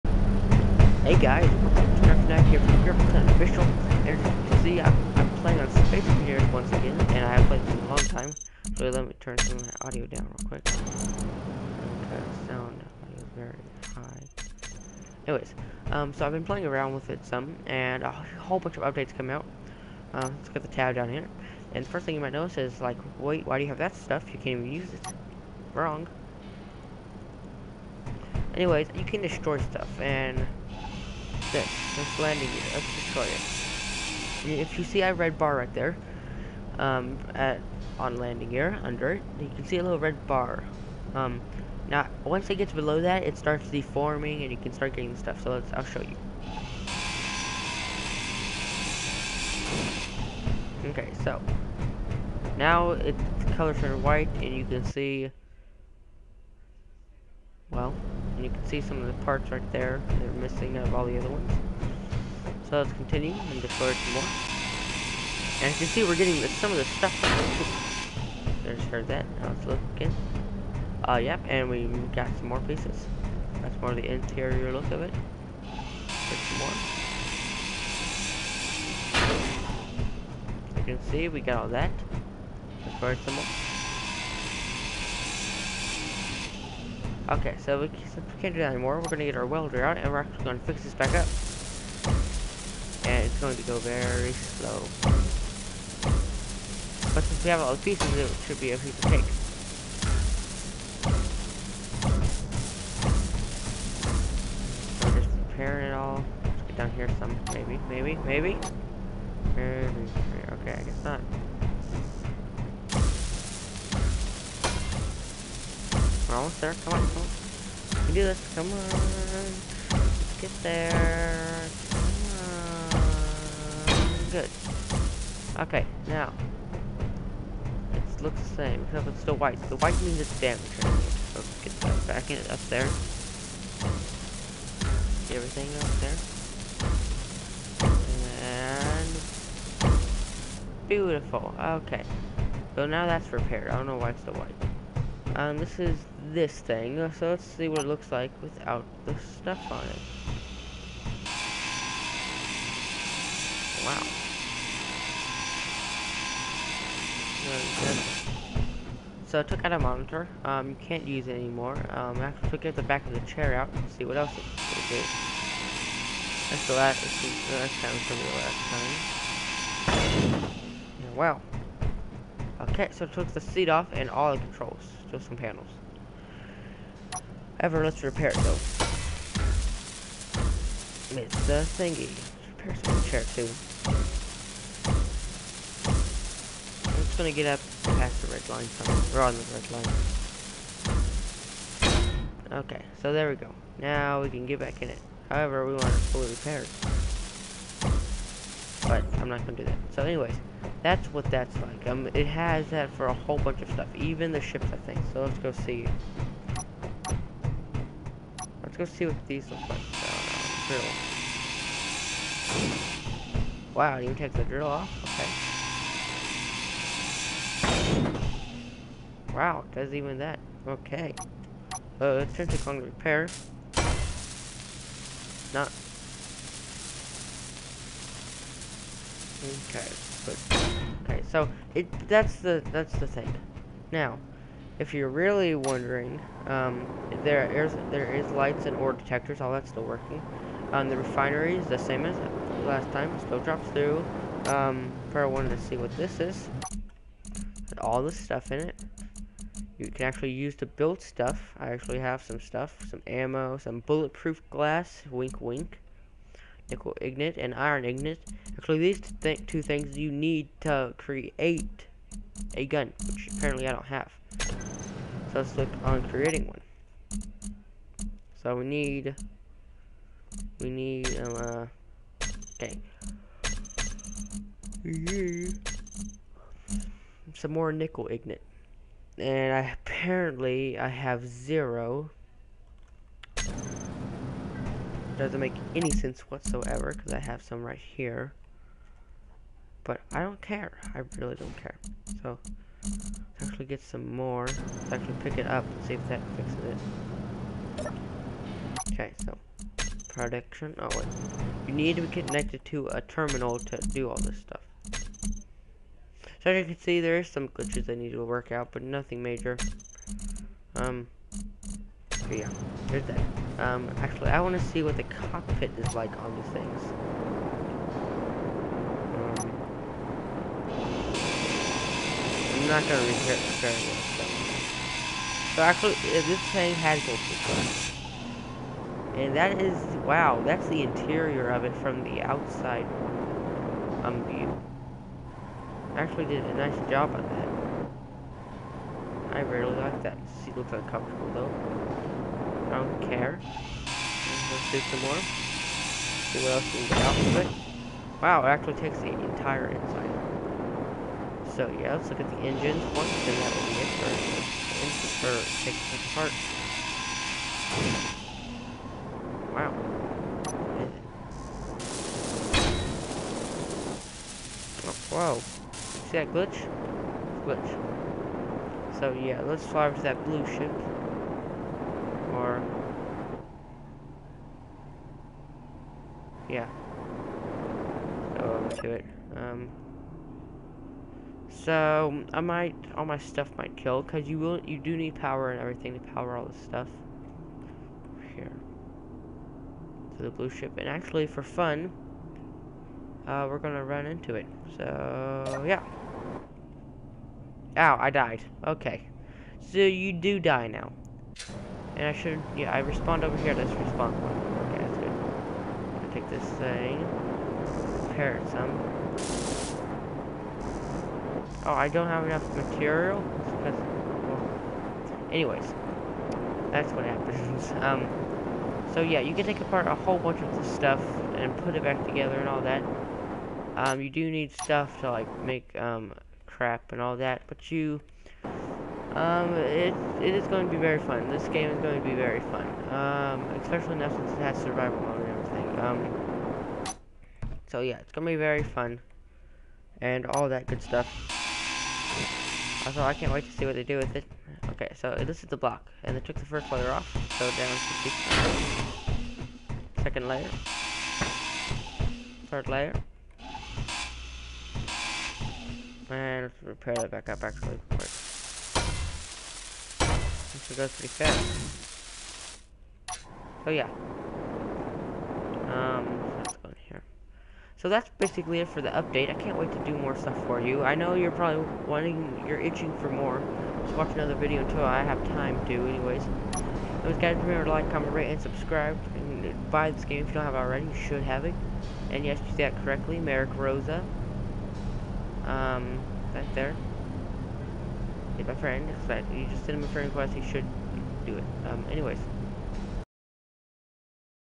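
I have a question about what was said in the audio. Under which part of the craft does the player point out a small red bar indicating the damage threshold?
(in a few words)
landing gear.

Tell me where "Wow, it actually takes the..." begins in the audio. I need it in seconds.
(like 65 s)
348 s.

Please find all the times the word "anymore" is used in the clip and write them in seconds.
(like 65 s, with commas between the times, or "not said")
88 s, 161 s.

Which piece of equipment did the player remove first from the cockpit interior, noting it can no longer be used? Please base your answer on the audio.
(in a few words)
monitor.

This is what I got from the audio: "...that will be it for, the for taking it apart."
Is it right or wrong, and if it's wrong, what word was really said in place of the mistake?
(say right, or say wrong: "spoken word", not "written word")
right.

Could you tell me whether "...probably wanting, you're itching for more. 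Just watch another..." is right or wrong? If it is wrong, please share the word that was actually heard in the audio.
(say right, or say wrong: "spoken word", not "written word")
right.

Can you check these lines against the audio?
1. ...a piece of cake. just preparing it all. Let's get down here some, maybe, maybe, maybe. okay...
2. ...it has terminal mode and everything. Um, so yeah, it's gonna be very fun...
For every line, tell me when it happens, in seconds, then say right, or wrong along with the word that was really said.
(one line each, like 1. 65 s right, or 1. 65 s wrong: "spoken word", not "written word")
1. 98 s right
2. 434 s wrong: "survival", not "terminal".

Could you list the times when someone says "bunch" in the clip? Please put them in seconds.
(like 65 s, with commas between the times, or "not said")
18 s, 203 s, 420 s.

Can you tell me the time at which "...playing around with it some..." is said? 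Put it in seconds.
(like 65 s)
16 s.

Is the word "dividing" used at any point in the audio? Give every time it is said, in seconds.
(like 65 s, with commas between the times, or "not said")
not said.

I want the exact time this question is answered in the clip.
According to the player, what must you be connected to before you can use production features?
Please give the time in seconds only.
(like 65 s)
303 s.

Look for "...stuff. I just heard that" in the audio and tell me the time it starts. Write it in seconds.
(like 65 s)
66 s.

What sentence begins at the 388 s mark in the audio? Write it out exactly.
Here to the blue ship, and actually for fun, uh, we're gonna run into it.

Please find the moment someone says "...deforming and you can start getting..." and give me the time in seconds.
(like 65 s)
43 s.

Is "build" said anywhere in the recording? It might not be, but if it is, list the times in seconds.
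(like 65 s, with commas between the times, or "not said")
250 s.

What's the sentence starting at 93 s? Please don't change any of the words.
And it's going to go very slow.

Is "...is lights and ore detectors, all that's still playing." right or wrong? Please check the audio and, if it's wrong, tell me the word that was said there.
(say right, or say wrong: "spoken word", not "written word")
wrong: "working", not "playing".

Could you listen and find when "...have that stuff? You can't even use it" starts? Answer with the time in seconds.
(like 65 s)
23 s.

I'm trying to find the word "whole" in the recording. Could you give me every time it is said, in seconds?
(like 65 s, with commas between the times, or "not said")
18 s, 203 s, 419 s.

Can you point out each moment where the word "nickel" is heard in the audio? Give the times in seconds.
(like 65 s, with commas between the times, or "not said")
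256 s, 277 s.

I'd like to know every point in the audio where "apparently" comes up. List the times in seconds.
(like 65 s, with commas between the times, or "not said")
263 s, 279 s.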